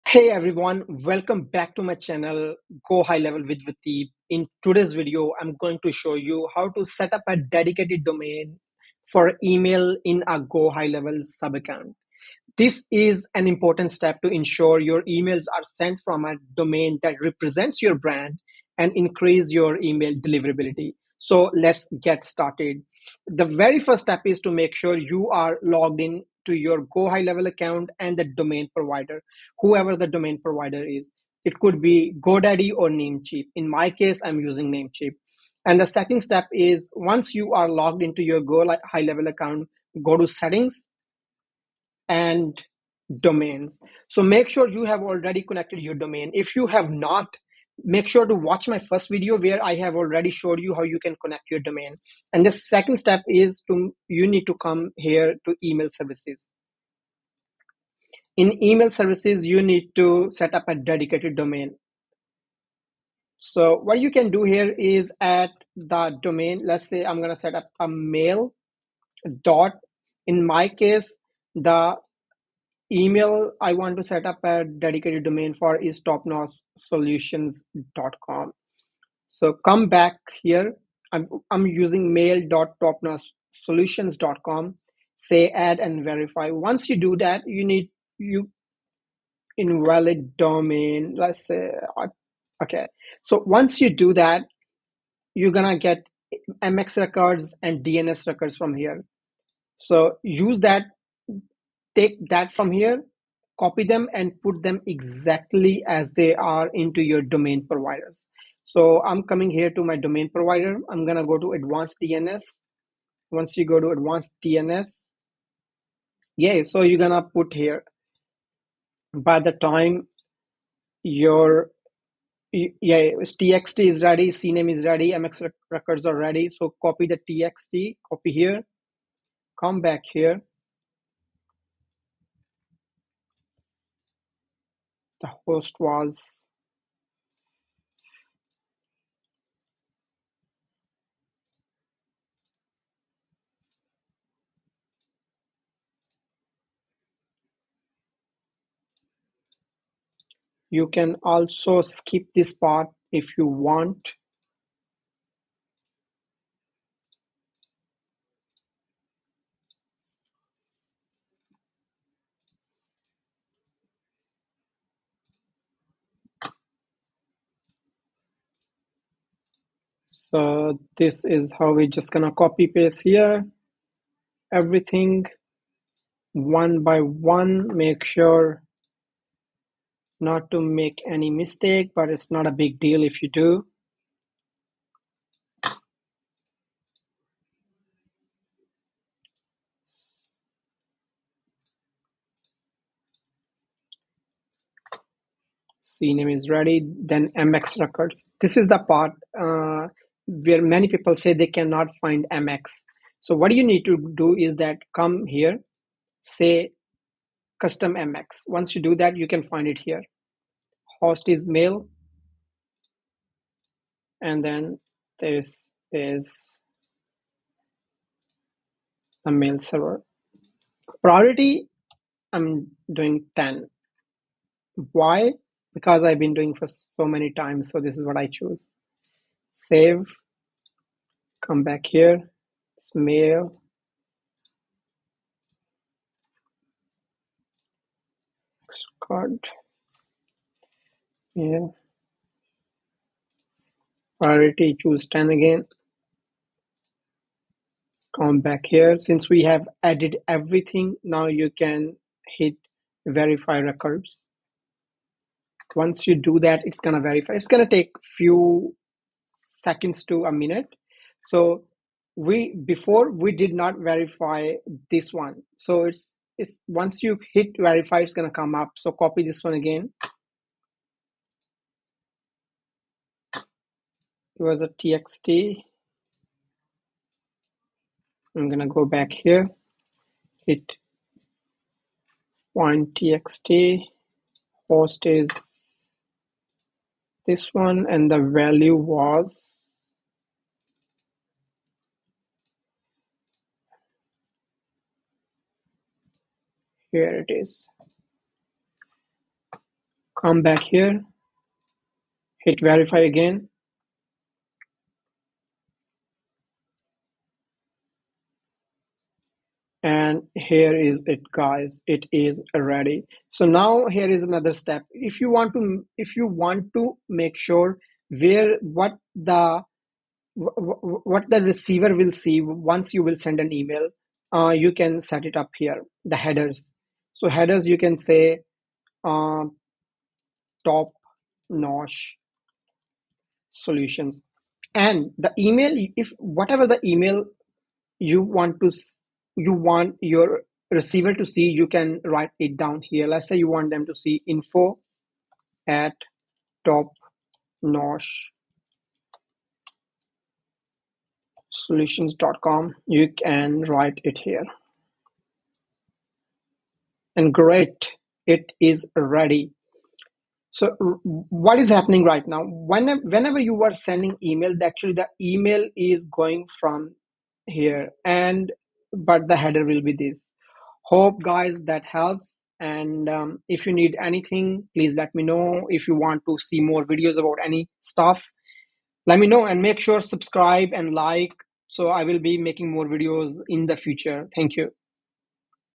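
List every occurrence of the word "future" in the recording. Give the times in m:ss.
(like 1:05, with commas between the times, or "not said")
6:23.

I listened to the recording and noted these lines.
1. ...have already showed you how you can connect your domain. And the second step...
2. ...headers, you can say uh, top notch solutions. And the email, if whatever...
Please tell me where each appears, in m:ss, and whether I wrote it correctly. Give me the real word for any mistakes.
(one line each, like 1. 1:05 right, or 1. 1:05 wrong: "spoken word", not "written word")
1. 0:49 right
2. 5:27 right.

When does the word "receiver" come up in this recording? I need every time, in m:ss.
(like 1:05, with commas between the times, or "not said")
5:21, 5:40.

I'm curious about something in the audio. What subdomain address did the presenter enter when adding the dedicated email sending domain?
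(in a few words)
mail.topnotchsolutions.com.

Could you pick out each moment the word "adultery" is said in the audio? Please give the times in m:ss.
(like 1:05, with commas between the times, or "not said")
not said.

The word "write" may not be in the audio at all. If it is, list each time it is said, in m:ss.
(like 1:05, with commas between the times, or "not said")
5:42, 5:53.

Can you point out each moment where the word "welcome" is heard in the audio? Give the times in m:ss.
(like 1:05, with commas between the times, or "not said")
0:01.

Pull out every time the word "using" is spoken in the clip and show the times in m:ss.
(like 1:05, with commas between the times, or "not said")
0:34, 1:21.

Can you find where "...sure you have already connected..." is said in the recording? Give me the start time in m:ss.
0:44.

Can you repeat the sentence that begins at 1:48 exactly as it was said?
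So I'm coming here to my domain provider.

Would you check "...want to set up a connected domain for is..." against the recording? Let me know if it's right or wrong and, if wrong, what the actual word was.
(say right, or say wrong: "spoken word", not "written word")
wrong: "dedicated", not "connected".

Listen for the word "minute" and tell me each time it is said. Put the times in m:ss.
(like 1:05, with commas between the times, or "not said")
4:20.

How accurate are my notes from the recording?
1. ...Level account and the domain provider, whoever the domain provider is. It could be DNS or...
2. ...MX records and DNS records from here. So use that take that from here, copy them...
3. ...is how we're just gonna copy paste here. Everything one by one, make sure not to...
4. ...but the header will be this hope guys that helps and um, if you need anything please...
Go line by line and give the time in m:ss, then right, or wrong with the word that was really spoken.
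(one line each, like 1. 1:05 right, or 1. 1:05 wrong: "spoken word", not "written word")
1. 0:27 wrong: "GoDaddy", not "DNS"
2. 1:36 right
3. 2:51 right
4. 6:09 right.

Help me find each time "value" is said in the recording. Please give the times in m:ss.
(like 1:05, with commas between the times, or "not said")
4:48.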